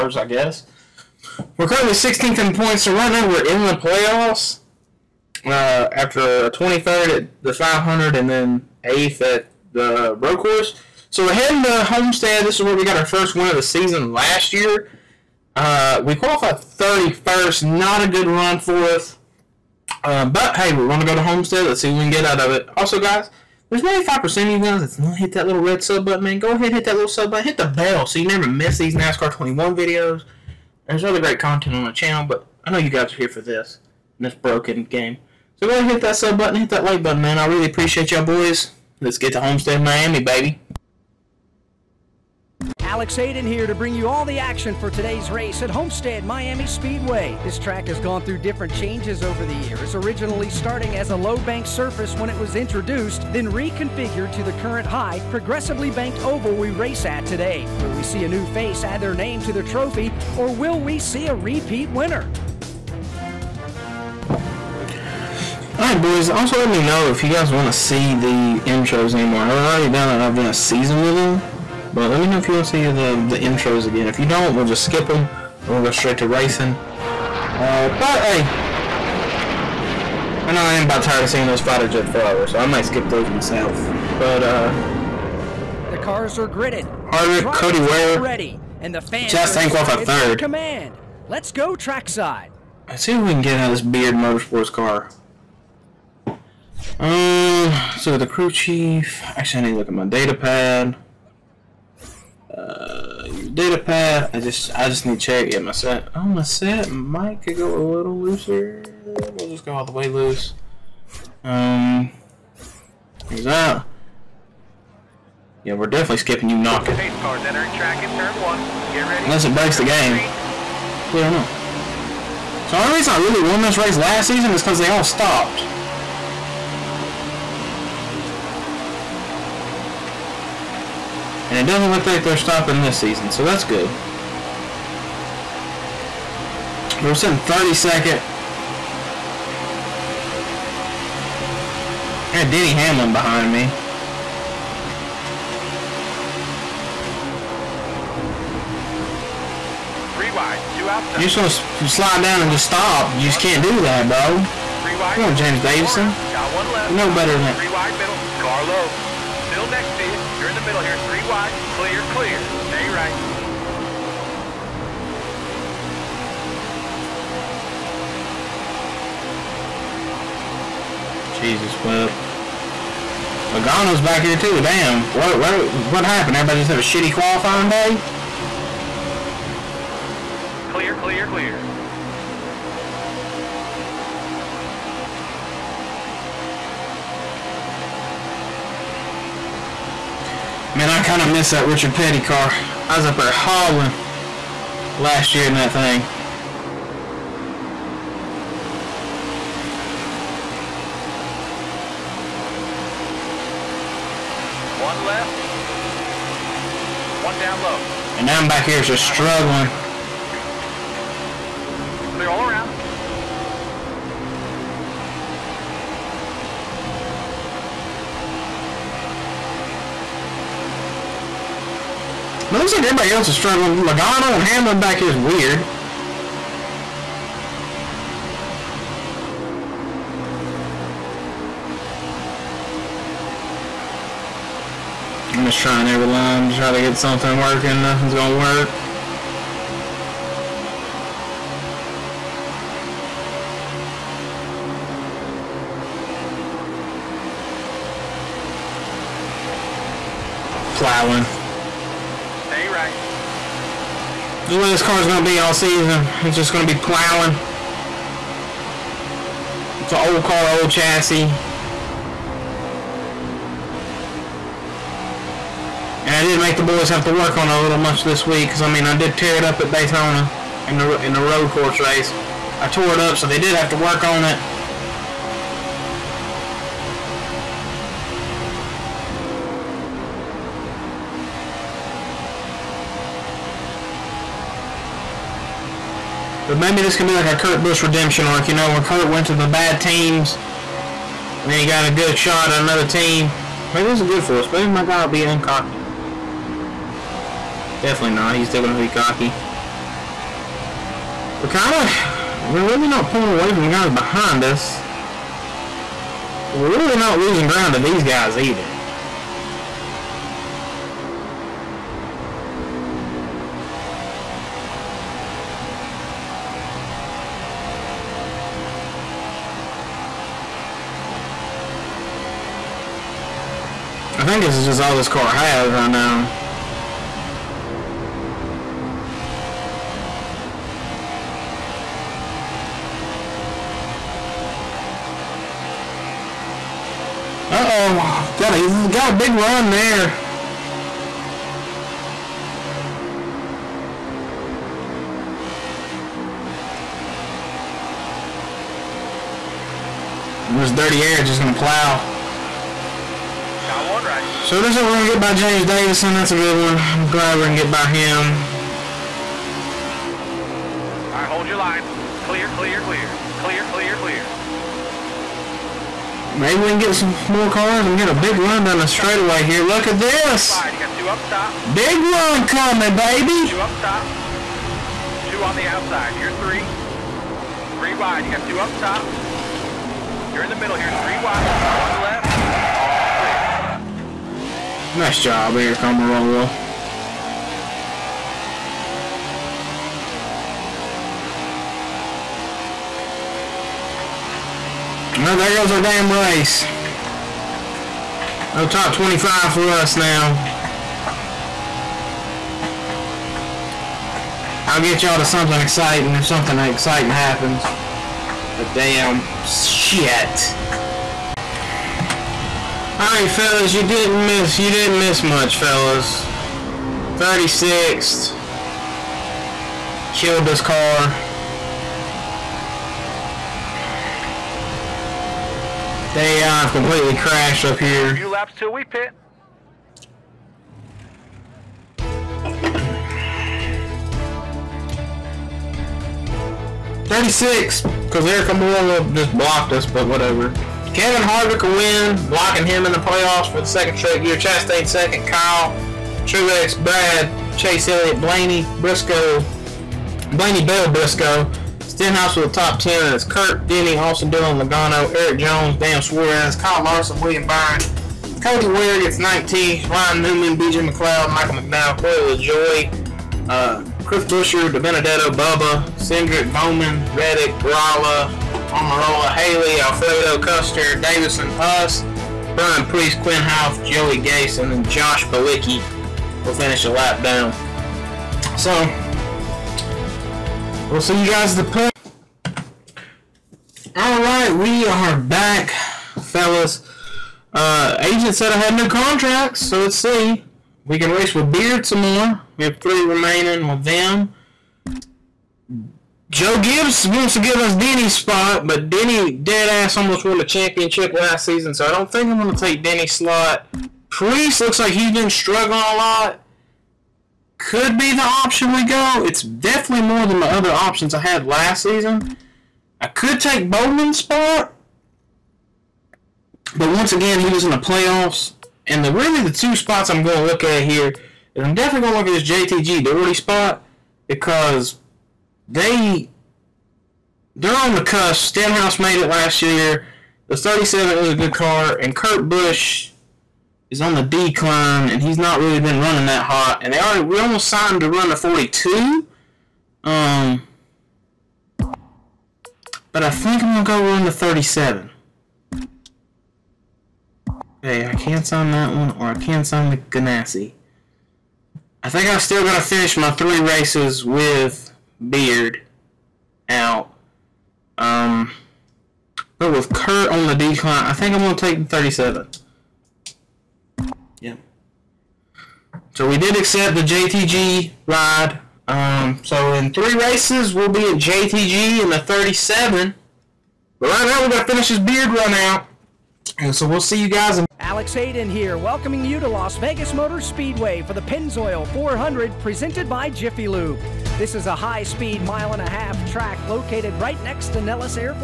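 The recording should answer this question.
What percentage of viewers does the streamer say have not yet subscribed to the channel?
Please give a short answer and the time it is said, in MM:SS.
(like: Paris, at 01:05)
95%, at 00:23.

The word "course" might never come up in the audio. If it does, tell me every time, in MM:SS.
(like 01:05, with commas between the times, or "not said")
00:10, 04:31.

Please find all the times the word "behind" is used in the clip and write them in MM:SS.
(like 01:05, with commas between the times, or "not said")
02:23, 05:03.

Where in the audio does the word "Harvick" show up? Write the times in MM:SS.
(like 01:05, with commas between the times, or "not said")
01:27, 07:21.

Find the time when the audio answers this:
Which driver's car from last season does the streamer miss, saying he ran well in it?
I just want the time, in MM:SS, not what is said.
03:11.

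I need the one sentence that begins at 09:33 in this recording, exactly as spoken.
But right now, we got to finish this beard run out.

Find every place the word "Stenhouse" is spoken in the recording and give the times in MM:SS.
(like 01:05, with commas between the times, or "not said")
07:32, 08:48.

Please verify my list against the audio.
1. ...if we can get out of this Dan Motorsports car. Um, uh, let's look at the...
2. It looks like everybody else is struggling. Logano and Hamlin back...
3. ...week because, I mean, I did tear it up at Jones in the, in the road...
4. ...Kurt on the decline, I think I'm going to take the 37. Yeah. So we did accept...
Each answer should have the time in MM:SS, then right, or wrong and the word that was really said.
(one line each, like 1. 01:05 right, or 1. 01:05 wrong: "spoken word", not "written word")
1. 01:33 wrong: "Beard", not "Dan"
2. 03:42 right
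3. 04:28 wrong: "Daytona", not "Jones"
4. 09:19 right.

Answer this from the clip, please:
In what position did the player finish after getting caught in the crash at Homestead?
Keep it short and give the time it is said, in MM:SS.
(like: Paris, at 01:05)
36th, at 06:57.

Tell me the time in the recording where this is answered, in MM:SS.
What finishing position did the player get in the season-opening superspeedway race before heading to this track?
00:06.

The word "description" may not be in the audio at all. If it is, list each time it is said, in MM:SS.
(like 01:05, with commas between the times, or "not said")
not said.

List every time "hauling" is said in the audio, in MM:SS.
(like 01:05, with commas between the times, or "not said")
03:13.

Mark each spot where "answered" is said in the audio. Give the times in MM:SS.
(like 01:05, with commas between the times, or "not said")
not said.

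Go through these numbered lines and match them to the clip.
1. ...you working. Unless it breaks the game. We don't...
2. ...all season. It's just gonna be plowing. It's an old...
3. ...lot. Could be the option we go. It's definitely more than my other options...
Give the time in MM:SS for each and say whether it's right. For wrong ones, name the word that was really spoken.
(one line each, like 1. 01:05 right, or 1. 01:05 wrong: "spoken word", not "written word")
1. 01:56 wrong: "knocking", not "working"
2. 04:15 right
3. 08:25 right.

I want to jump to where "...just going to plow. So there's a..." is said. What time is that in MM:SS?
05:51.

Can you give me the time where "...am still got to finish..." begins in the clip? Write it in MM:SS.
09:12.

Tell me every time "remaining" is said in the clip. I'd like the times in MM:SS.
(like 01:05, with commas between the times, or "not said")
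08:13.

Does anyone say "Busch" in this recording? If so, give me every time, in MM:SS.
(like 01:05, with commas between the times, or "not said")
04:47, 08:52.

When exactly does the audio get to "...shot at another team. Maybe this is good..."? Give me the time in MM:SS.
04:52.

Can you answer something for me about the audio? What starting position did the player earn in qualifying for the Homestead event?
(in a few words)
31st.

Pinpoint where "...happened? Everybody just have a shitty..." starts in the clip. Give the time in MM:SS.
02:56.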